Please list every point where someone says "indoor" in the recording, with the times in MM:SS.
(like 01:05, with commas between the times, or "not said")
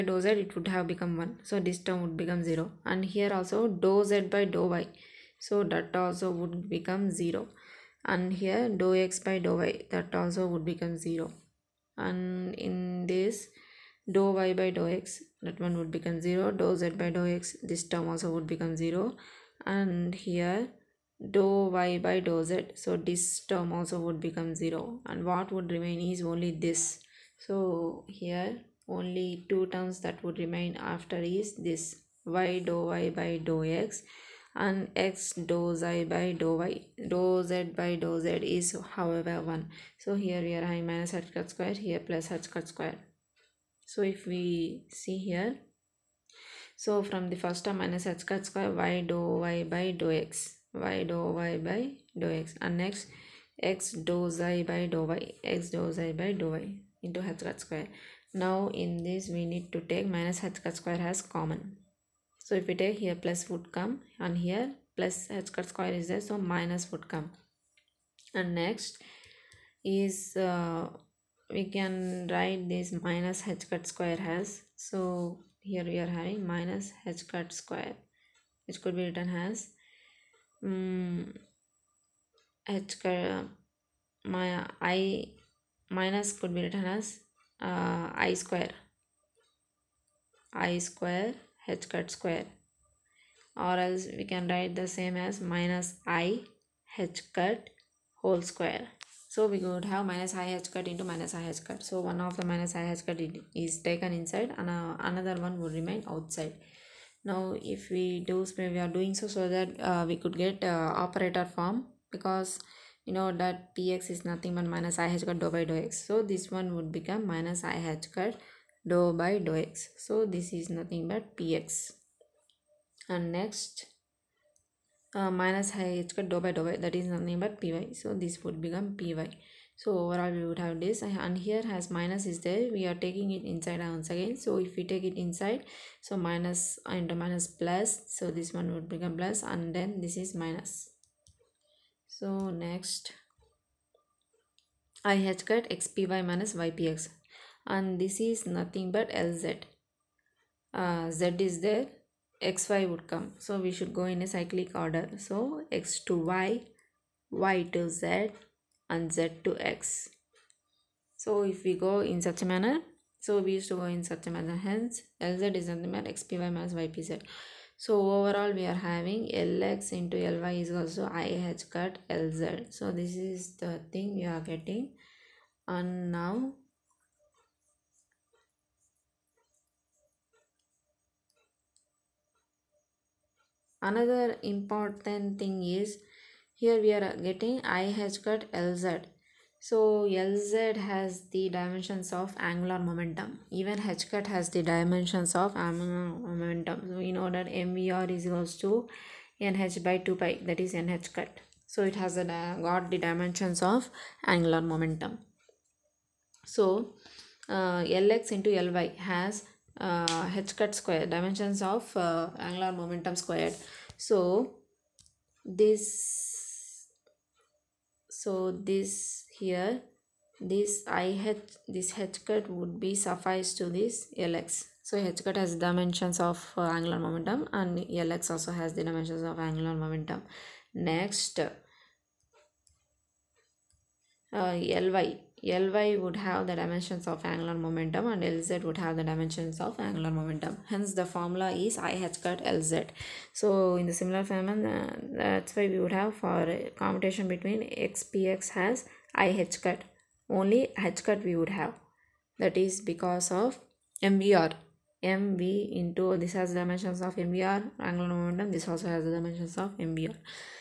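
not said.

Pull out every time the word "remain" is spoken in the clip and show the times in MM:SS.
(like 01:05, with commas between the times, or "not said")
00:25, 00:30, 01:45.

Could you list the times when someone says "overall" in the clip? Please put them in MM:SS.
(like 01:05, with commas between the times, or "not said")
02:10, 02:48.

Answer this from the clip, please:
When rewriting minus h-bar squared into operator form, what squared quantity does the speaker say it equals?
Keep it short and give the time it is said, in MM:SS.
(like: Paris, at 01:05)
minus i h cut whole square, at 01:35.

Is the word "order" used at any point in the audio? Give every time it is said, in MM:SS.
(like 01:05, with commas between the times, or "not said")
02:34, 03:17.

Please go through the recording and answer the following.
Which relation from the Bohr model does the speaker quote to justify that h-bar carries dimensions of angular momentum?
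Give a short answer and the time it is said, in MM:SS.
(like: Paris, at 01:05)
mvr = nh/2π, at 03:17.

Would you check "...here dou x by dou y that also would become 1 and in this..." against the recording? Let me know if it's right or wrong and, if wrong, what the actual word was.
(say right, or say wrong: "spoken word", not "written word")
wrong: "0", not "1".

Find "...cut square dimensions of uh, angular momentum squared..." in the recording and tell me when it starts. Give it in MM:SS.
03:30.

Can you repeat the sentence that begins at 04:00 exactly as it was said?
Hence the formula is IH cut Lz.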